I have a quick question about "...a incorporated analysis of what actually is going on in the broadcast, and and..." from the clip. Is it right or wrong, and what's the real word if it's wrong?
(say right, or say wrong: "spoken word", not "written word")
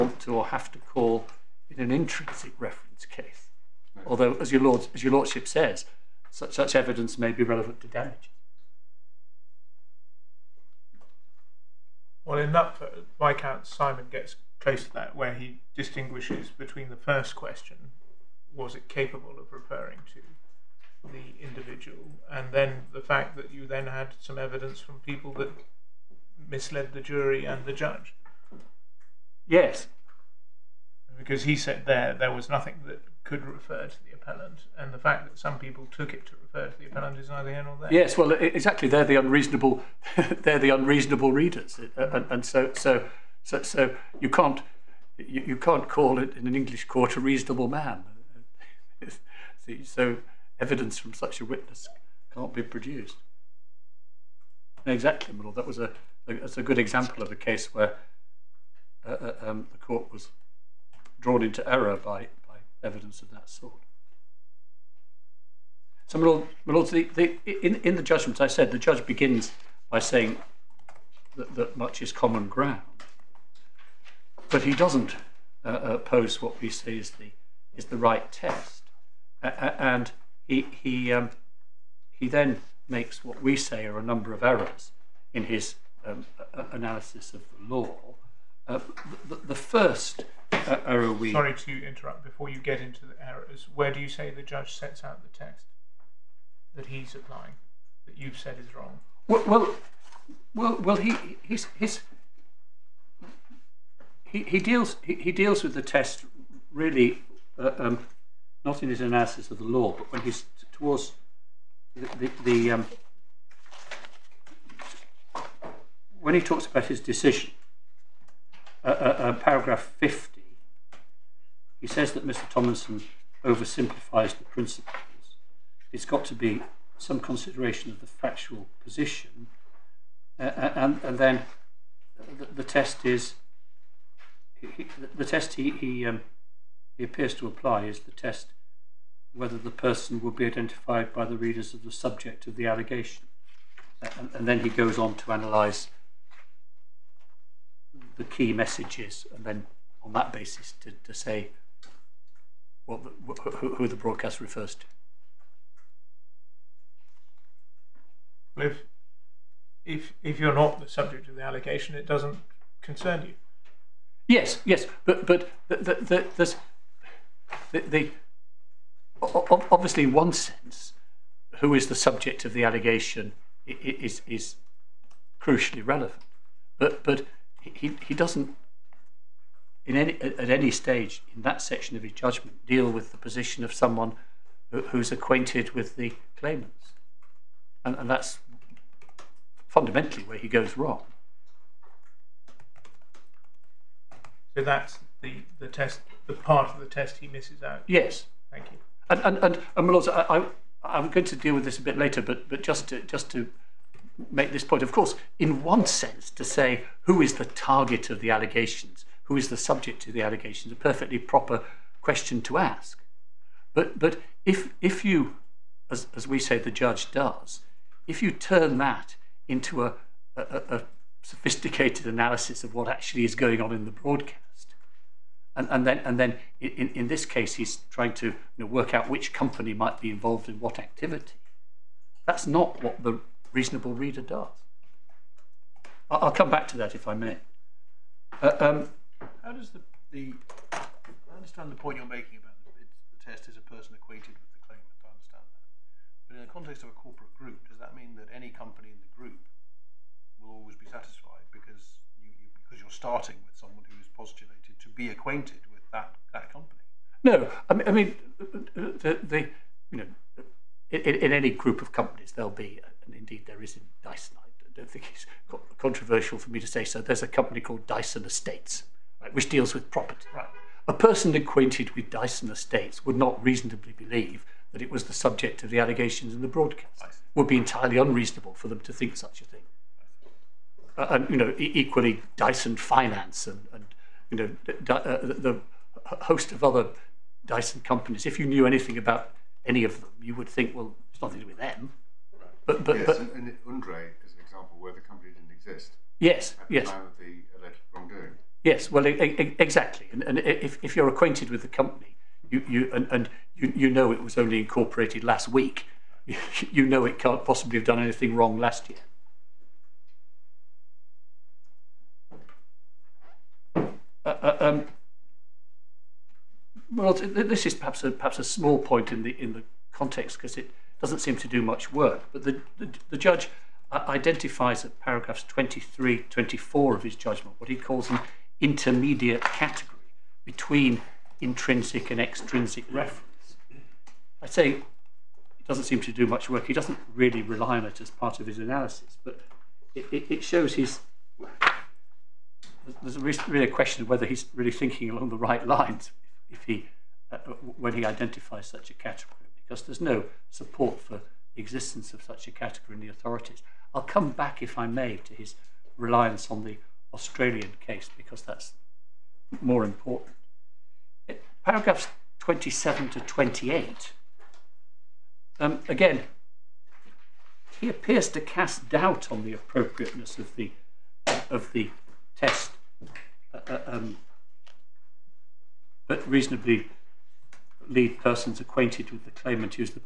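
wrong: "sophisticated", not "incorporated".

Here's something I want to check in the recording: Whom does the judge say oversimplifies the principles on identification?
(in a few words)
Mr. Tomlinson.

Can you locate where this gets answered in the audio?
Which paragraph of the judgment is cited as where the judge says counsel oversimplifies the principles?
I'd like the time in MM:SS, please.
01:59.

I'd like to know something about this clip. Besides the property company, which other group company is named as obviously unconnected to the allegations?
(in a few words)
Dyson Finance.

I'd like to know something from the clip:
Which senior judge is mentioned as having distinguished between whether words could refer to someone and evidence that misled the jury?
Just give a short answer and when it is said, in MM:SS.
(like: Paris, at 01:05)
Viscount Simon, at 00:13.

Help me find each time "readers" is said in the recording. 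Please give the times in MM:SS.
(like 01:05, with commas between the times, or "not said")
00:41, 02:21, 03:53.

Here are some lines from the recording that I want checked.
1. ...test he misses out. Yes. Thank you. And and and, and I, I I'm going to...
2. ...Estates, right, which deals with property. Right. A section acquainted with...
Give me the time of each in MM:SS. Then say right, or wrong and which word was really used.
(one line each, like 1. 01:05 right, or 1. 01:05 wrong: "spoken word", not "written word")
1. 03:16 right
2. 04:28 wrong: "person", not "section".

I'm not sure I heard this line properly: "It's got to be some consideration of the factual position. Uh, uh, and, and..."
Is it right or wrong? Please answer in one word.
right.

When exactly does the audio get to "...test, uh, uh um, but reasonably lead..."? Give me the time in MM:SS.
06:12.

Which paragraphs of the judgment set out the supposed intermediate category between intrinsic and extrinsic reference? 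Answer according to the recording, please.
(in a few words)
23, 24.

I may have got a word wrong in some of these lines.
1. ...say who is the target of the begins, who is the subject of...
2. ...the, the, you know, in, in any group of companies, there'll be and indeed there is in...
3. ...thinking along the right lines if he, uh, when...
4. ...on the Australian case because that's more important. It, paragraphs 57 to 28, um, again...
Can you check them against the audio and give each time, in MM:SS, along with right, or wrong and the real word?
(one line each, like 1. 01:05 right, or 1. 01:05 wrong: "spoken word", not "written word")
1. 03:26 wrong: "allegations", not "begins"
2. 04:19 right
3. 05:44 right
4. 05:56 wrong: "27", not "57".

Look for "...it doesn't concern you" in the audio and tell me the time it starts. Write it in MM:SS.
02:41.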